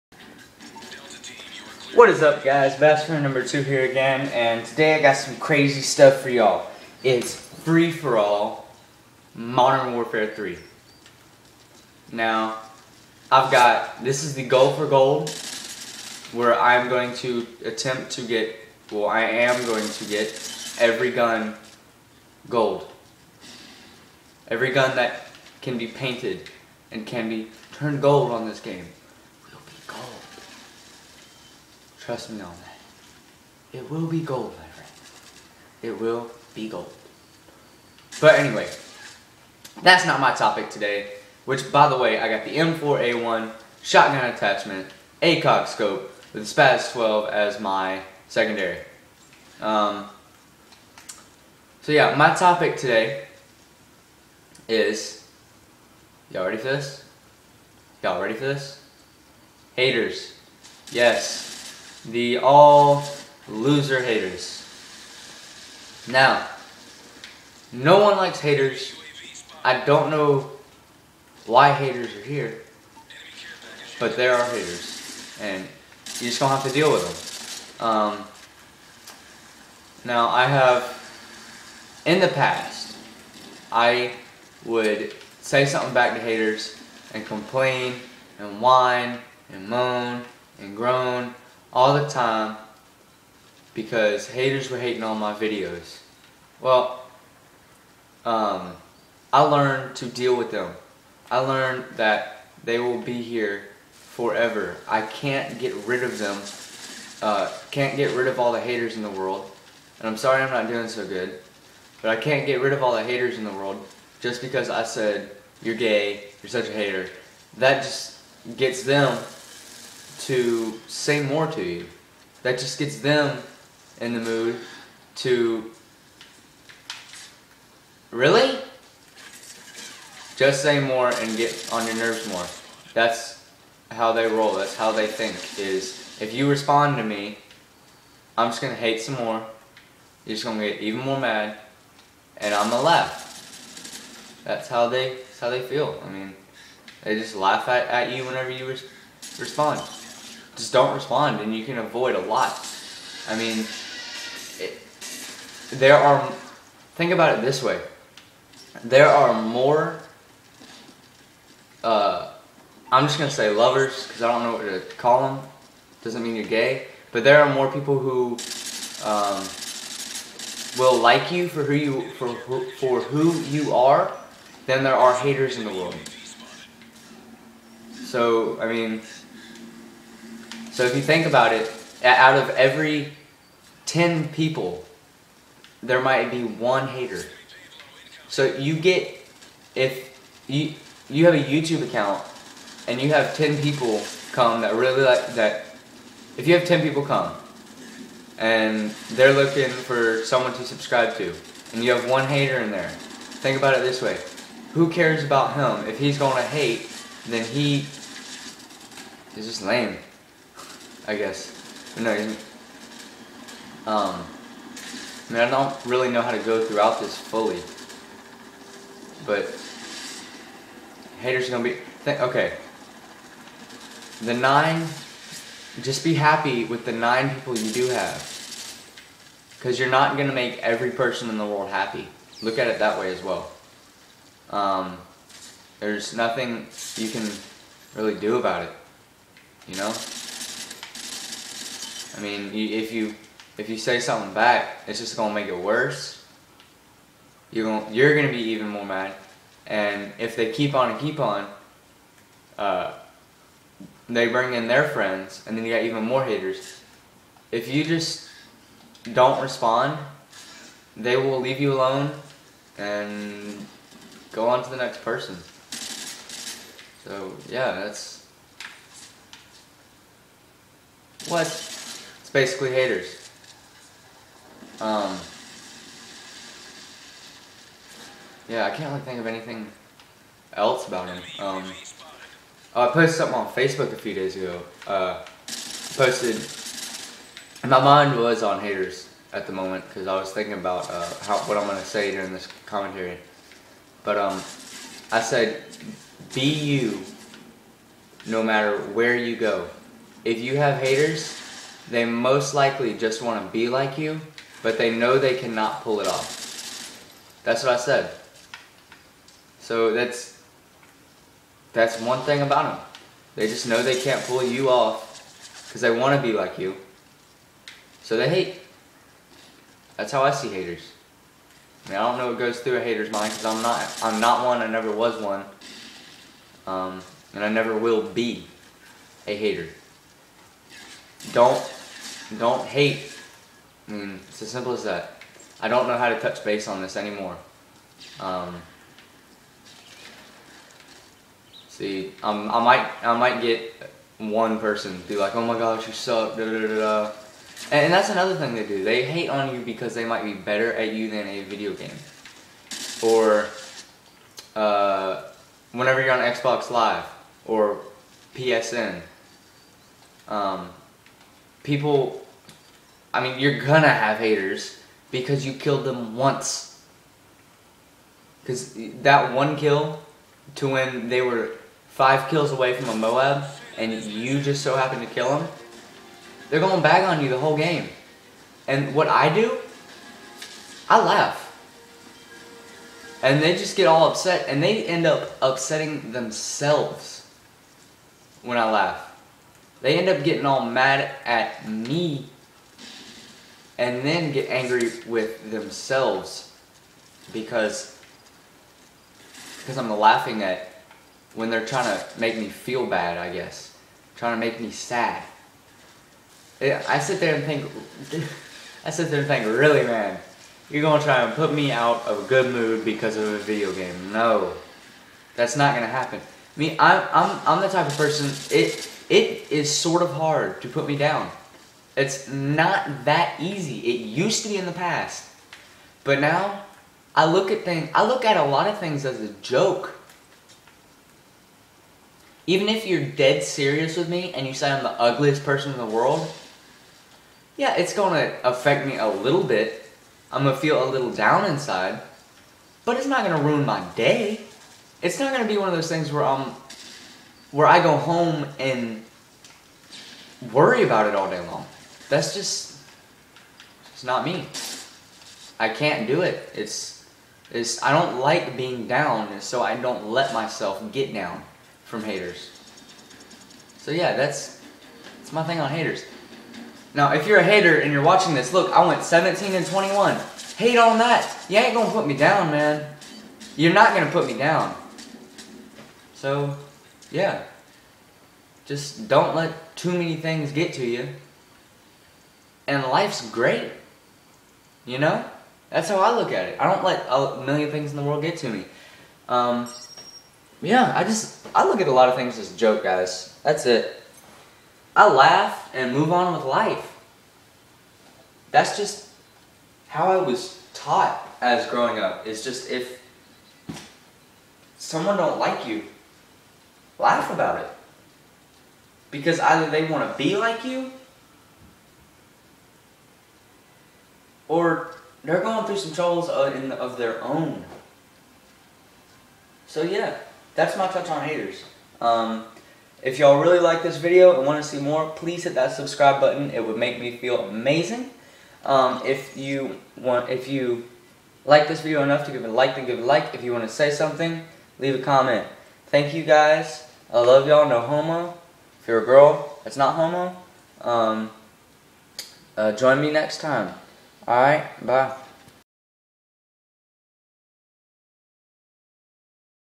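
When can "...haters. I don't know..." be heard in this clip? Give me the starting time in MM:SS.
01:08.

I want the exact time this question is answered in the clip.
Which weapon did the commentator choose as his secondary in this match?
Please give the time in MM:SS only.
00:46.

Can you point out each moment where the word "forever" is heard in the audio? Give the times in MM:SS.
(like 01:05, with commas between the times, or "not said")
01:43.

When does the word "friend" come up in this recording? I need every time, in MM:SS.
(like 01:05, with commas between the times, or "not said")
00:34, 04:14.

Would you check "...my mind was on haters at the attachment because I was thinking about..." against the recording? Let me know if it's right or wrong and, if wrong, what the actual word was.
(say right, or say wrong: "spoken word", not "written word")
wrong: "moment", not "attachment".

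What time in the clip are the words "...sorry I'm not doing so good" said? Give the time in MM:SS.
01:50.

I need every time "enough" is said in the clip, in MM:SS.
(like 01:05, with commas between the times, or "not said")
08:52.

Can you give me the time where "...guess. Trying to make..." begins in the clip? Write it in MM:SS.
06:43.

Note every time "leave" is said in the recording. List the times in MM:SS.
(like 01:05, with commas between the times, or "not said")
04:21, 08:54.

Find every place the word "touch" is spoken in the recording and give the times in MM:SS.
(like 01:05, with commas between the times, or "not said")
05:36, 08:40.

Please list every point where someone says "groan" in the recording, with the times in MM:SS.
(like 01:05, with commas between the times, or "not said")
01:30.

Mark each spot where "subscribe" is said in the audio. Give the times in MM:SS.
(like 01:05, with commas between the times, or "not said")
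03:20, 08:45.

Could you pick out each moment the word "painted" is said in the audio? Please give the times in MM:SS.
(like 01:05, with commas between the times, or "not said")
00:25.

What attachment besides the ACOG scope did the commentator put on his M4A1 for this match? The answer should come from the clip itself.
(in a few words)
shotgun attachment.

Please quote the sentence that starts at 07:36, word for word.
It's it's I don't like being down, and so I don't let myself get down from haters.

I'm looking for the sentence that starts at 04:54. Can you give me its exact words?
But um, I said, be you no matter where you go.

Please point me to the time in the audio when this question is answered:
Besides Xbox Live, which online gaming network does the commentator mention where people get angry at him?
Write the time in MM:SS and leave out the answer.
05:58.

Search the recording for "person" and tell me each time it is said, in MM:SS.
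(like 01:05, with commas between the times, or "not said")
03:50, 04:25, 05:44, 06:57, 07:15.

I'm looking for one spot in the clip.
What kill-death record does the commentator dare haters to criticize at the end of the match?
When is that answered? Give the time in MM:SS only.
07:49.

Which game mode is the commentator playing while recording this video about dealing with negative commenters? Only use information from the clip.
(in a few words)
Free For All.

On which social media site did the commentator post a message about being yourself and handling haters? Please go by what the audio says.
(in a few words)
Facebook.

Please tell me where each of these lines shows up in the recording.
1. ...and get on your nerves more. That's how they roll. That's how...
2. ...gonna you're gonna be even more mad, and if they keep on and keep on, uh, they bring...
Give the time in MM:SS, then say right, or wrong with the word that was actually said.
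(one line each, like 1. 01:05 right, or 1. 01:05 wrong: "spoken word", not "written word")
1. 02:11 right
2. 04:07 right.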